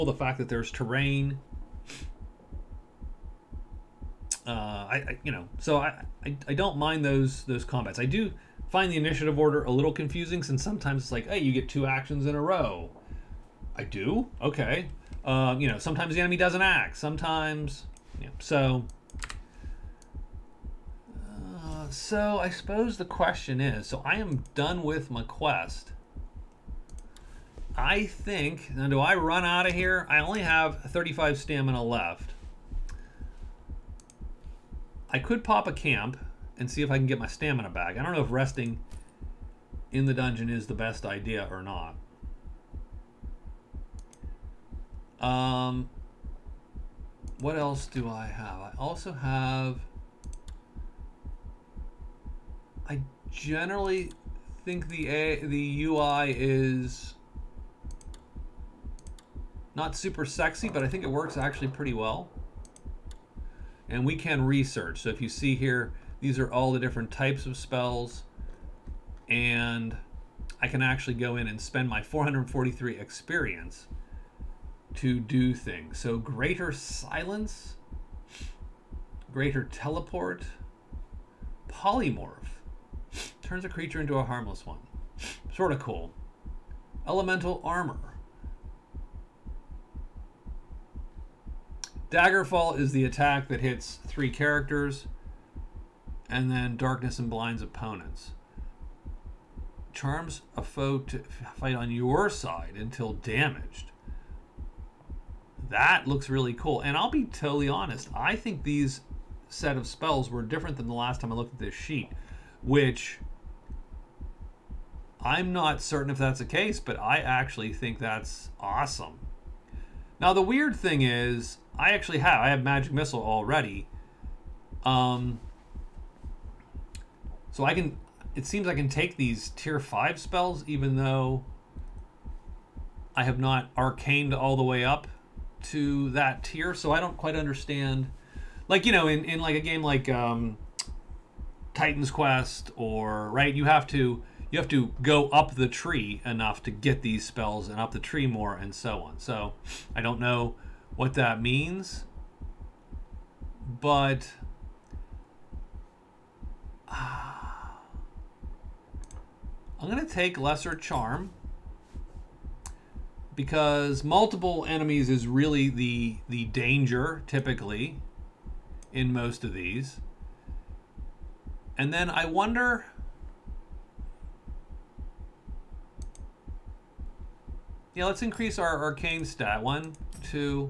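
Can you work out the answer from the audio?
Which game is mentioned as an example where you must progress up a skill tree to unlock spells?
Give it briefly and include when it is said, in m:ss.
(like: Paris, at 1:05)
Titan's Quest, at 2:21.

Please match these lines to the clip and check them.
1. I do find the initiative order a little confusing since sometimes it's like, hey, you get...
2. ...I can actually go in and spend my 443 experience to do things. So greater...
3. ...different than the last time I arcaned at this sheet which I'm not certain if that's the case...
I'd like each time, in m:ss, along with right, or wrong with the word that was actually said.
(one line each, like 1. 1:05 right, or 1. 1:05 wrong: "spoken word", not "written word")
1. 0:07 right
2. 1:10 right
3. 1:50 wrong: "looked", not "arcaned".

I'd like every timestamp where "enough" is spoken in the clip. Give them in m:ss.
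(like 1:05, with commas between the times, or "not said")
2:26.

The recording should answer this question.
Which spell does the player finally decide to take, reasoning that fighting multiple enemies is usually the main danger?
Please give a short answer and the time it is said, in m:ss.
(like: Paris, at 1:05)
Lesser Charm, at 2:40.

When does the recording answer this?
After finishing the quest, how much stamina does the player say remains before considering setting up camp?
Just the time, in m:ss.
0:30.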